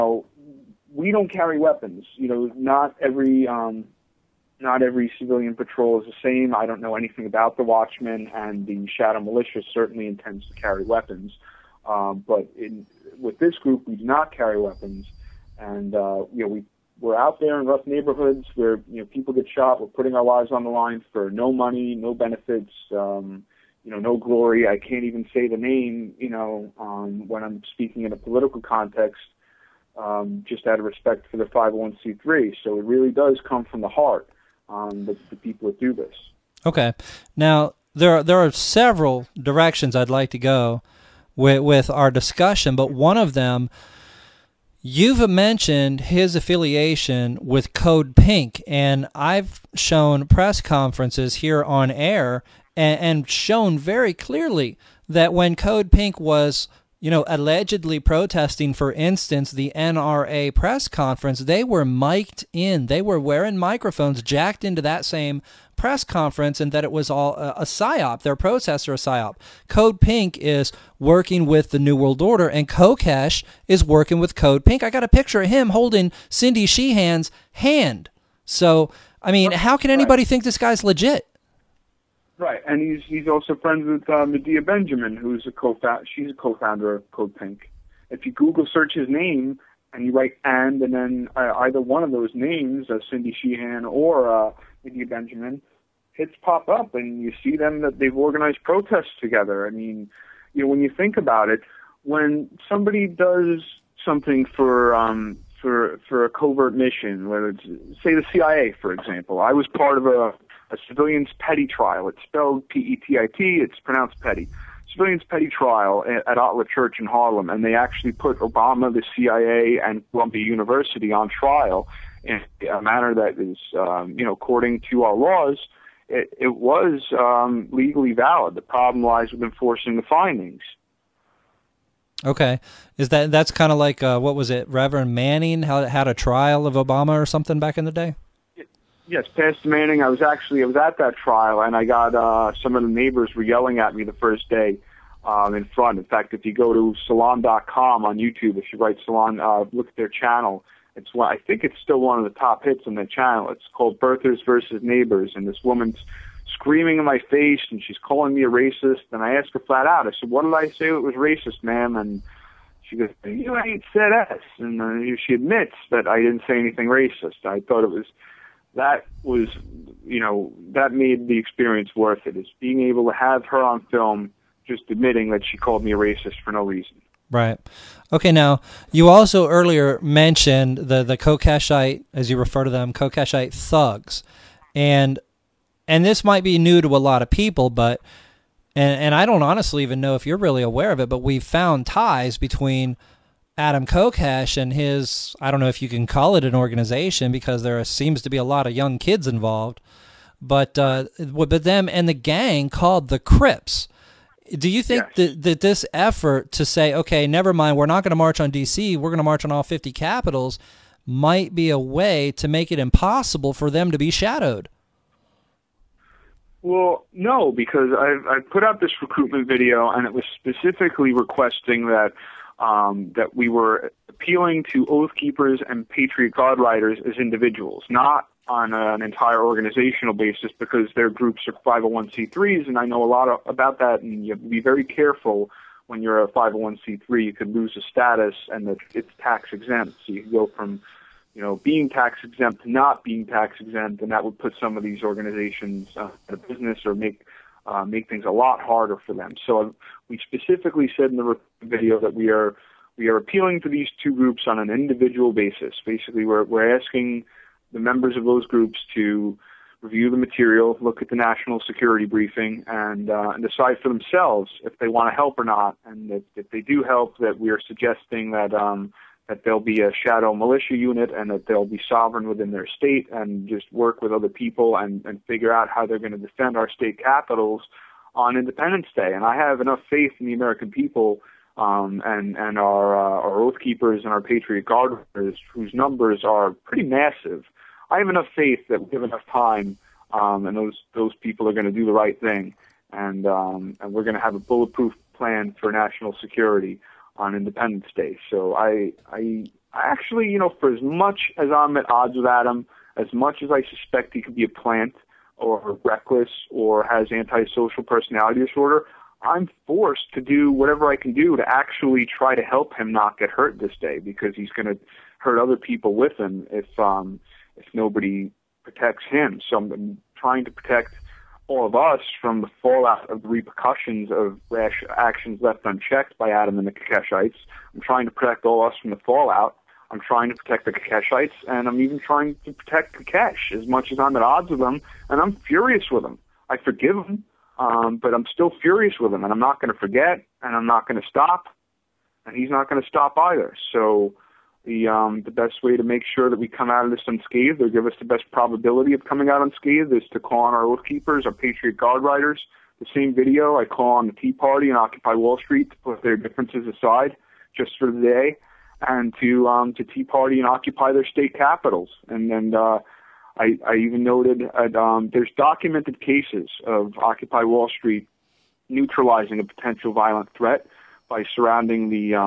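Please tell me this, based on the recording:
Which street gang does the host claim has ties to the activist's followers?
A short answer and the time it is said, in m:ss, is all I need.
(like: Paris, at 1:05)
the Crips, at 3:23.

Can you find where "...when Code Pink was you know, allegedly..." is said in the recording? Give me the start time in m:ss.
0:55.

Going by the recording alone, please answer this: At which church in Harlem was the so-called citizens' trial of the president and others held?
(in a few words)
ATLAH Church.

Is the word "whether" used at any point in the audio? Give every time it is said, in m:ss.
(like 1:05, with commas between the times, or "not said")
1:47.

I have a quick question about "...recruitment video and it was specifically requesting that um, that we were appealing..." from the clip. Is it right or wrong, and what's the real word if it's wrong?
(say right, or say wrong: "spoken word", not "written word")
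right.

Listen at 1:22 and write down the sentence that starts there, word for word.
Right, and he's he's also friends with uh, Medea Benjamin, who's a co she's a co-founder of Code Pink.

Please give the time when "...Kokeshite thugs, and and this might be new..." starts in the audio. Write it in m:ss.
3:02.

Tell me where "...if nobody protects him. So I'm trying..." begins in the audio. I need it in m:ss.
5:17.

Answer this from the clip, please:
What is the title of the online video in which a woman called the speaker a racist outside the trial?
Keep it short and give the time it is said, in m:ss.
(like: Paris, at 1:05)
Birthers versus Neighbors, at 2:33.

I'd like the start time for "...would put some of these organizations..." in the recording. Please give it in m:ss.
4:04.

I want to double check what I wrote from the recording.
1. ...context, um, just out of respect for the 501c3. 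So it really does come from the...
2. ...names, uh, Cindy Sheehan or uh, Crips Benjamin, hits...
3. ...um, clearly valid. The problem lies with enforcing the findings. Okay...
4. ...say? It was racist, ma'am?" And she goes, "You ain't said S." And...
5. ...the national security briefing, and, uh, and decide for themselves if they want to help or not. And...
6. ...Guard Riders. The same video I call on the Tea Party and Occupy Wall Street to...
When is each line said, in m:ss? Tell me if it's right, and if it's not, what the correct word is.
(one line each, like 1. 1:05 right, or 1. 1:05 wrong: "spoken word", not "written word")
1. 0:28 right
2. 1:32 wrong: "Medea", not "Crips"
3. 2:07 wrong: "legally", not "clearly"
4. 2:40 right
5. 4:21 right
6. 5:51 right.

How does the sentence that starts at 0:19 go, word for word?
We're putting our lives on the line for no money, no benefits.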